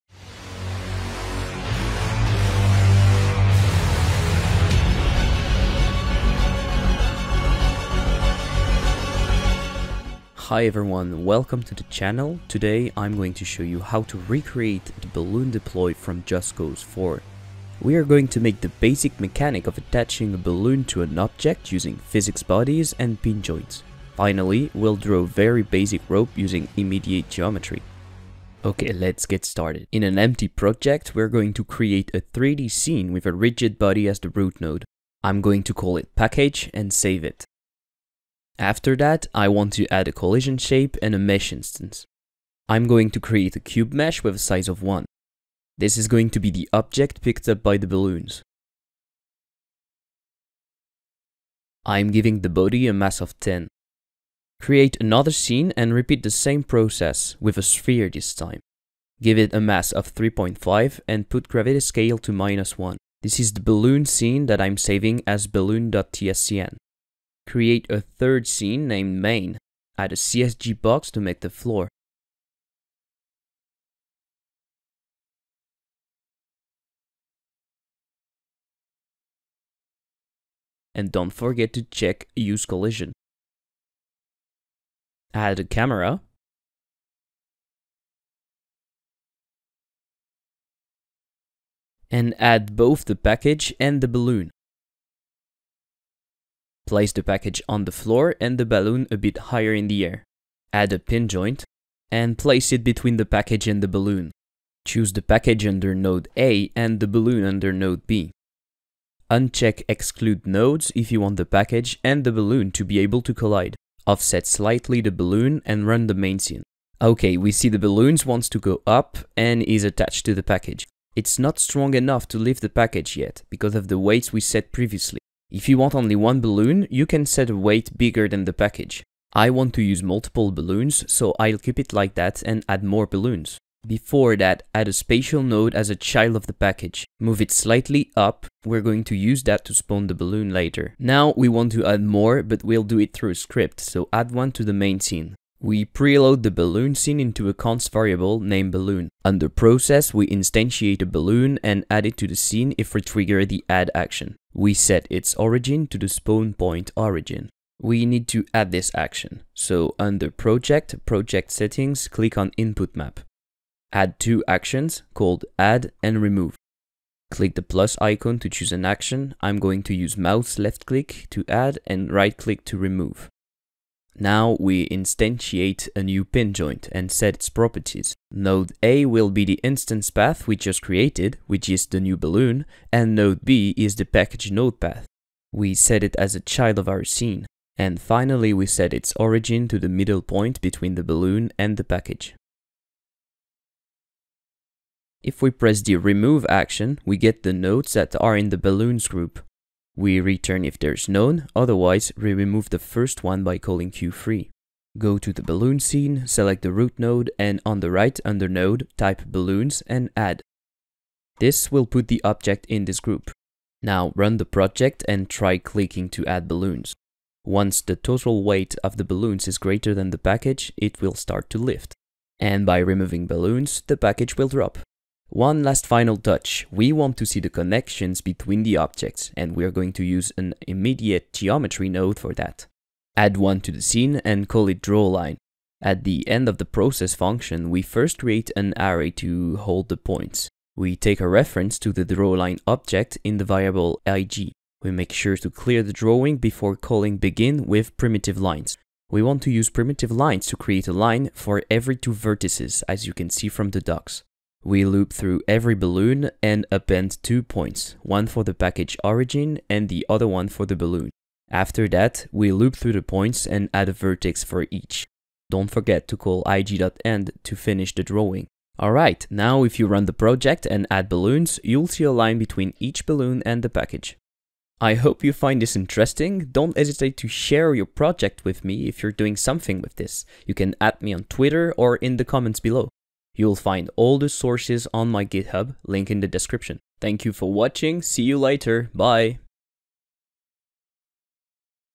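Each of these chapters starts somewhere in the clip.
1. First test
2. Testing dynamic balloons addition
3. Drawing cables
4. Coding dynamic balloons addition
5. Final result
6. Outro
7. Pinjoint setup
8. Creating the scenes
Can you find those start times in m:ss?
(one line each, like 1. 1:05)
1. 1:56
2. 3:33
3. 3:50
4. 2:25
5. 4:28
6. 4:43
7. 1:40
8. 0:30.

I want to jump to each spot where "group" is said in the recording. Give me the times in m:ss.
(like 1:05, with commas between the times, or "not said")
3:19, 3:33.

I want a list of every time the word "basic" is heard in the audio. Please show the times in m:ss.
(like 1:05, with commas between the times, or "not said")
0:18, 0:25.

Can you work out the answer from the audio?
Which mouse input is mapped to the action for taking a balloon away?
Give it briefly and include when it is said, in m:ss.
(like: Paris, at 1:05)
Right click, at 2:52.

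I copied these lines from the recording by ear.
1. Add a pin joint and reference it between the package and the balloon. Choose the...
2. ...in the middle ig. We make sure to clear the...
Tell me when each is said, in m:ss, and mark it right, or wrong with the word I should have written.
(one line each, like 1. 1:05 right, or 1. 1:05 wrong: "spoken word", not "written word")
1. 1:40 wrong: "place", not "reference"
2. 4:03 wrong: "variable", not "middle".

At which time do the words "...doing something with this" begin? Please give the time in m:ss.
4:39.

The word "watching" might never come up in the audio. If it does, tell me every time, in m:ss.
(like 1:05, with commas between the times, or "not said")
4:47.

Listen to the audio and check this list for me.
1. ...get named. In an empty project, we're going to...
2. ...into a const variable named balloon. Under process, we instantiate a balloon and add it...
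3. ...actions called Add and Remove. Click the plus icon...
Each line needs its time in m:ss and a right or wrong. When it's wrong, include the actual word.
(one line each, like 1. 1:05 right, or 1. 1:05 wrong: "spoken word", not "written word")
1. 0:29 wrong: "started", not "named"
2. 2:27 right
3. 2:44 right.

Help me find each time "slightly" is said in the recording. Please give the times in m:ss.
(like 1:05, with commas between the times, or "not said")
1:54, 2:17.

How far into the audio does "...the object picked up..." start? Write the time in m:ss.
0:46.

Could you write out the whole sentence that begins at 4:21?
After that, we loop through the points and add a vertex for each.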